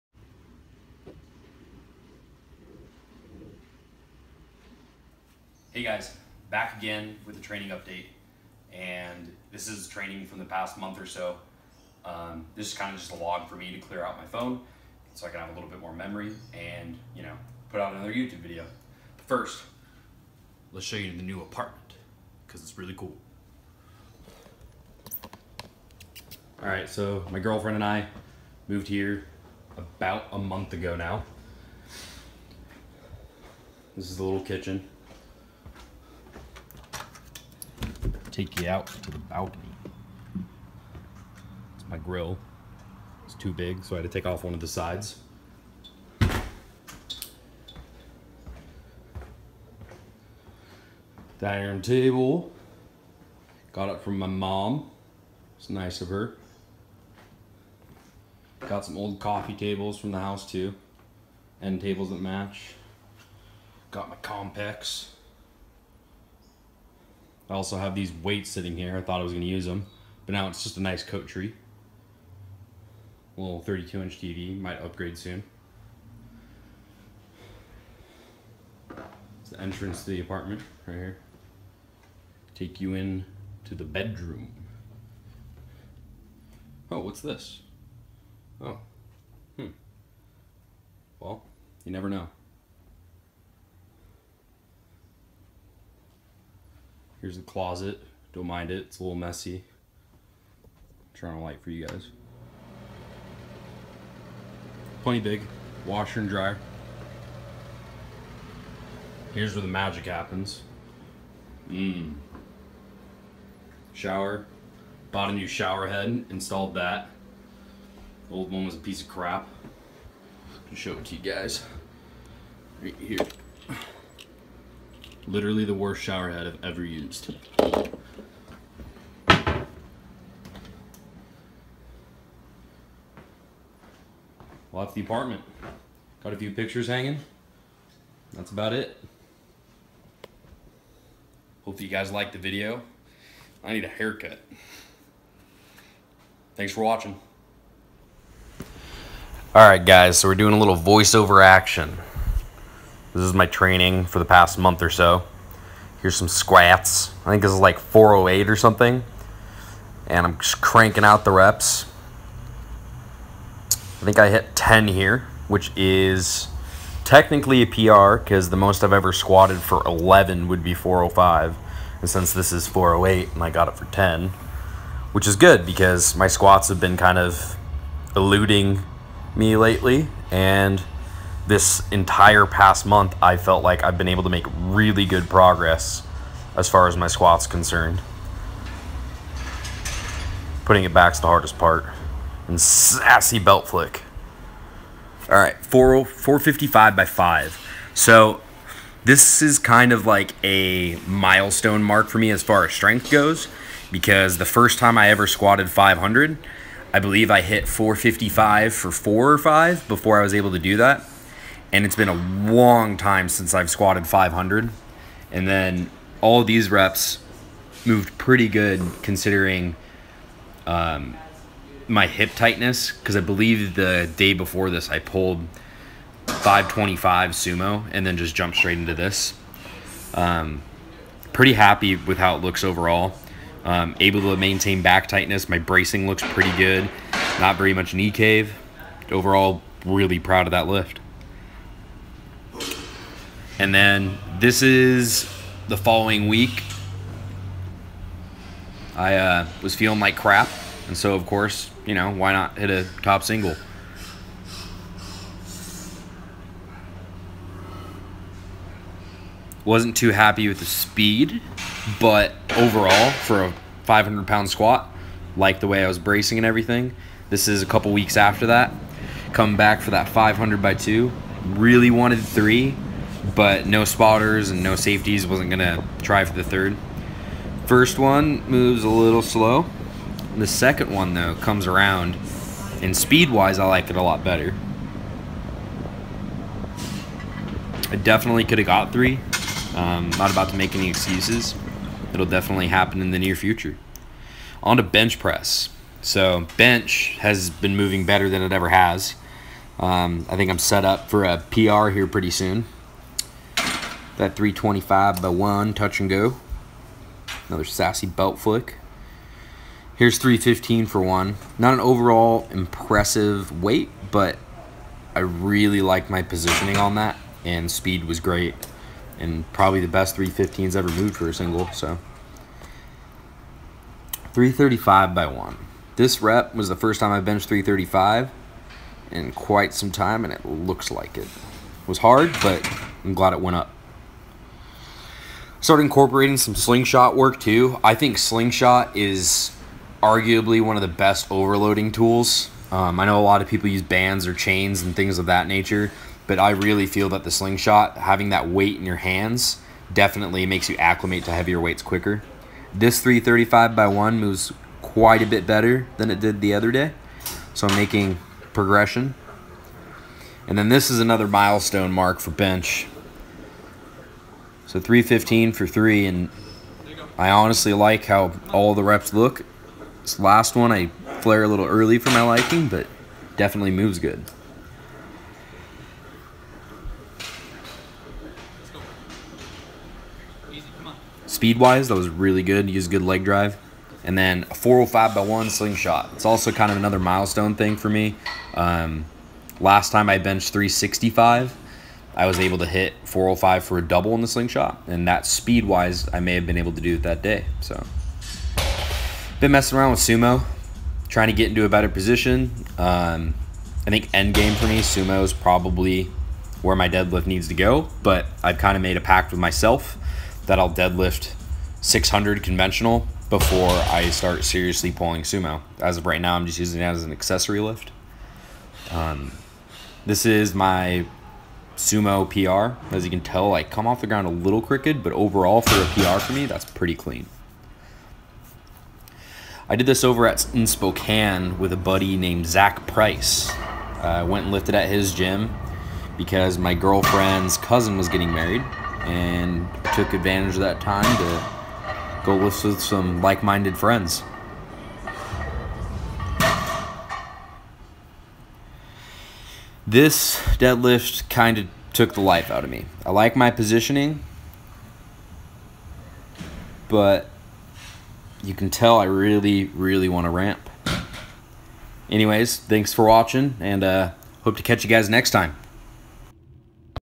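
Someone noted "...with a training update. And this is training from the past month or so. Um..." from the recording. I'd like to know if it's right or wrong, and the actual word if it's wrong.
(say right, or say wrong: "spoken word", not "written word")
right.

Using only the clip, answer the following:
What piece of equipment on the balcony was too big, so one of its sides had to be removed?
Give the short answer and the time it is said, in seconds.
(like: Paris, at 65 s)
grill, at 41 s.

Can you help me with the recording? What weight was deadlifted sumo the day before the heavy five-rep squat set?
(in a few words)
525.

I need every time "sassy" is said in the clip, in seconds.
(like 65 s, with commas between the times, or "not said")
192 s, 307 s.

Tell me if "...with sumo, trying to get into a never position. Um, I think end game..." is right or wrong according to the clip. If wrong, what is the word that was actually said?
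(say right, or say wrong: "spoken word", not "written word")
wrong: "better", not "never".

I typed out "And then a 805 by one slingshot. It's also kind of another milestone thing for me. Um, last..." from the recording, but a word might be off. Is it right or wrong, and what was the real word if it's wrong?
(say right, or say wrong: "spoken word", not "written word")
wrong: "405", not "805".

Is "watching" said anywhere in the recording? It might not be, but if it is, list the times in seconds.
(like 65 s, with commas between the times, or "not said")
146 s, 463 s.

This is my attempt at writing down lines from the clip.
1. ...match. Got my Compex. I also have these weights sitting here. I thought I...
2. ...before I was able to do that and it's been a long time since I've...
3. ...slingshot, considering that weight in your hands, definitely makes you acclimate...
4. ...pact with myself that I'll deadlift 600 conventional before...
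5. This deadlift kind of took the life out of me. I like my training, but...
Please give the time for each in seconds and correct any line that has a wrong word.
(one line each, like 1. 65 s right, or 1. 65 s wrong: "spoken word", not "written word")
1. 62 s right
2. 209 s right
3. 347 s wrong: "having", not "considering"
4. 409 s right
5. 449 s wrong: "positioning", not "training".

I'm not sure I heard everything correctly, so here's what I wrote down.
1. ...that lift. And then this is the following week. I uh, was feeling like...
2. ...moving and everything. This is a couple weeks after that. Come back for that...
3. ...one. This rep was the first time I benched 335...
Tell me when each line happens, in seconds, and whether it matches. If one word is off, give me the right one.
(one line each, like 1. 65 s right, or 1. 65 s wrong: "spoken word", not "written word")
1. 240 s right
2. 265 s wrong: "bracing", not "moving"
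3. 325 s right.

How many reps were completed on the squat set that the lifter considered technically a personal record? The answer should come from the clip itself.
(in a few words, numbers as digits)
10.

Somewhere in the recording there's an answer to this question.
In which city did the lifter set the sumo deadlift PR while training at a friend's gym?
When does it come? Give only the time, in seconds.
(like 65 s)
430 s.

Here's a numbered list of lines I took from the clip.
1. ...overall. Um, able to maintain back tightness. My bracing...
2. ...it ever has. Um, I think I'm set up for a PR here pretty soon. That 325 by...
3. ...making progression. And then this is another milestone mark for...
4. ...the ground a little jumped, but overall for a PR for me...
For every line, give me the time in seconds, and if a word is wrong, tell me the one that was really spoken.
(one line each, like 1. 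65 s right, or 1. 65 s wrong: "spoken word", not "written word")
1. 232 s right
2. 298 s right
3. 357 s right
4. 424 s wrong: "crooked", not "jumped".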